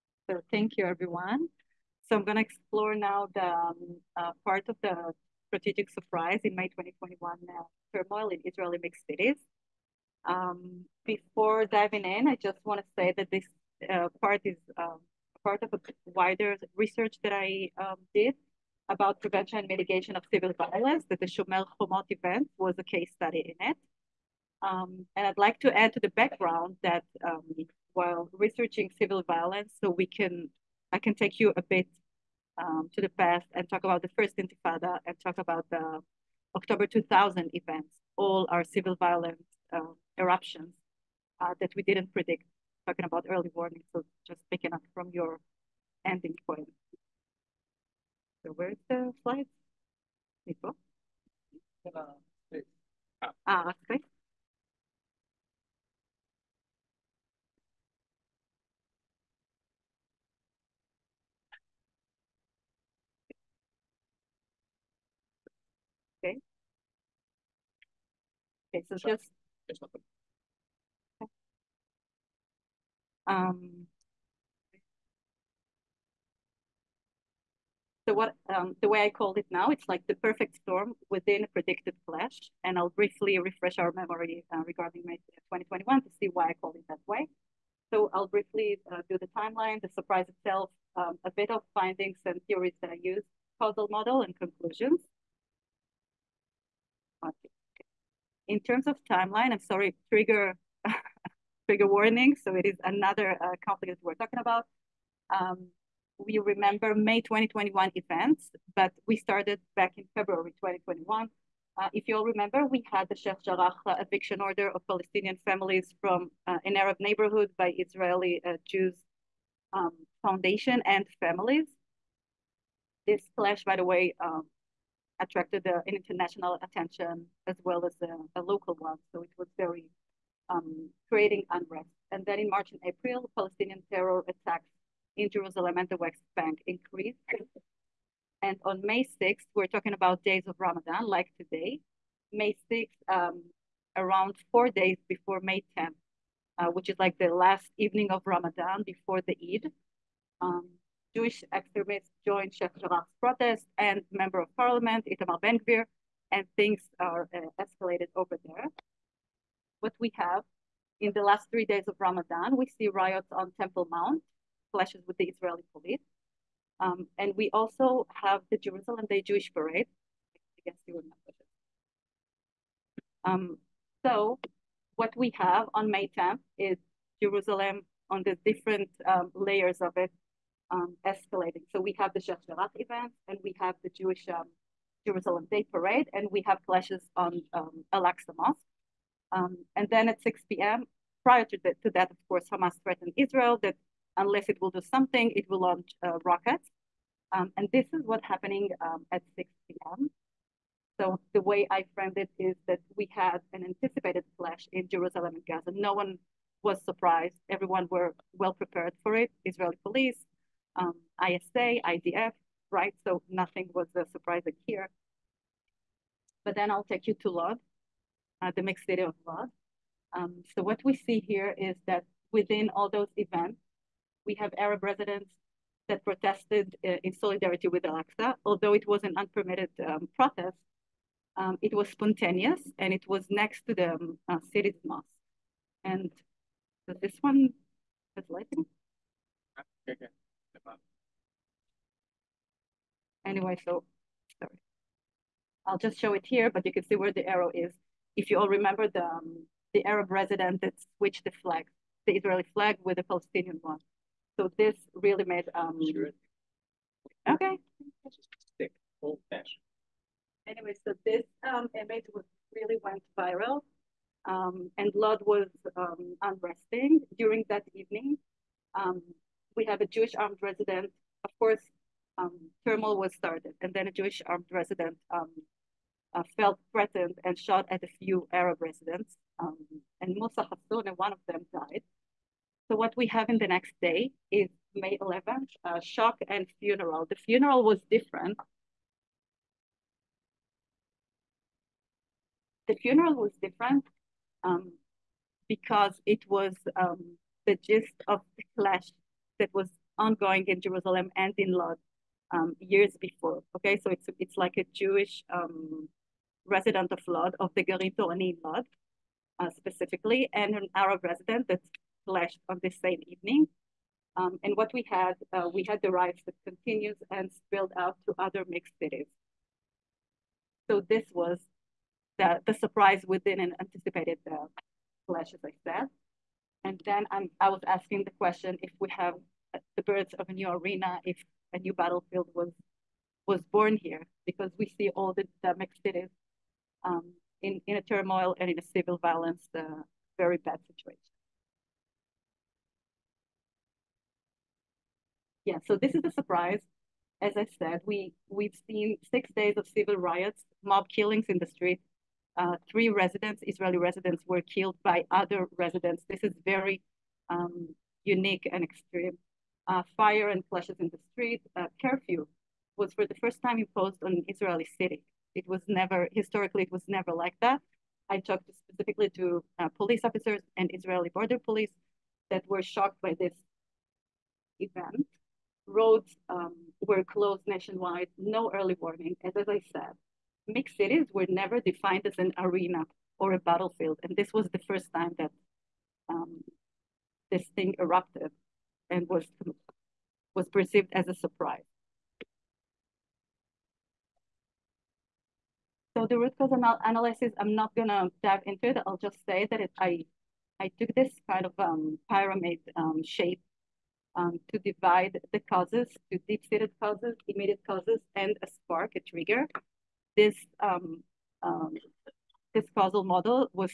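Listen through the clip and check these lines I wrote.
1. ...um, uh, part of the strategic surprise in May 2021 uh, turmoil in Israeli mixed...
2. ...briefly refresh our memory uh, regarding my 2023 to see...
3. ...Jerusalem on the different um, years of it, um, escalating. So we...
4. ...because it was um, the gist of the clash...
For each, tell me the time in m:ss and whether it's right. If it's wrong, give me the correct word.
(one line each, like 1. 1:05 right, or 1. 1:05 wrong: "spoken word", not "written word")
1. 0:03 right
2. 1:22 wrong: "2021", not "2023"
3. 2:57 wrong: "layers", not "years"
4. 4:55 right.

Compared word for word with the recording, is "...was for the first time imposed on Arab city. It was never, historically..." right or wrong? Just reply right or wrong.
wrong.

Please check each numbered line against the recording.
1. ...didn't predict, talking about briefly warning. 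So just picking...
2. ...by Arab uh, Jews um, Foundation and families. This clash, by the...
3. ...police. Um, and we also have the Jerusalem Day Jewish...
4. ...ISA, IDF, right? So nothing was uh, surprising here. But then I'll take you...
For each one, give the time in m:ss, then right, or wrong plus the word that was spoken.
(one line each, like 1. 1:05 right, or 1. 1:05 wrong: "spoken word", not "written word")
1. 0:41 wrong: "early", not "briefly"
2. 1:57 wrong: "Israeli", not "Arab"
3. 2:45 right
4. 3:31 right.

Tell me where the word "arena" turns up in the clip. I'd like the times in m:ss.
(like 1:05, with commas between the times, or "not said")
5:30, 6:22.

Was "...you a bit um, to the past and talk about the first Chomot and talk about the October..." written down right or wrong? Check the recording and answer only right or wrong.
wrong.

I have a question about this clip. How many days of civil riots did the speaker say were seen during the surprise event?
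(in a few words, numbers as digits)
6.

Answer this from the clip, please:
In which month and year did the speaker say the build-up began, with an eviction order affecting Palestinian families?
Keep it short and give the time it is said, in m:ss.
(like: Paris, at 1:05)
February 2021, at 1:50.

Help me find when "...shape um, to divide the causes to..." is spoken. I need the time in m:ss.
6:43.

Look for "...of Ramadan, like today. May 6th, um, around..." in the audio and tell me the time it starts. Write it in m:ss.
2:20.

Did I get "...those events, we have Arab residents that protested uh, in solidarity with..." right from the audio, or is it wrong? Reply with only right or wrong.
right.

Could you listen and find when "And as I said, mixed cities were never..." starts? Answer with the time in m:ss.
6:19.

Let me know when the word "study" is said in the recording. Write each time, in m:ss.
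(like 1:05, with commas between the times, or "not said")
0:23.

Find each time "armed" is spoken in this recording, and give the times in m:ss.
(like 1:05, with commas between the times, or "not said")
4:30, 4:34.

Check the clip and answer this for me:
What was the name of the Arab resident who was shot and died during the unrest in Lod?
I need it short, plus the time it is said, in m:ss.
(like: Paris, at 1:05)
Musa Hassoun, at 4:40.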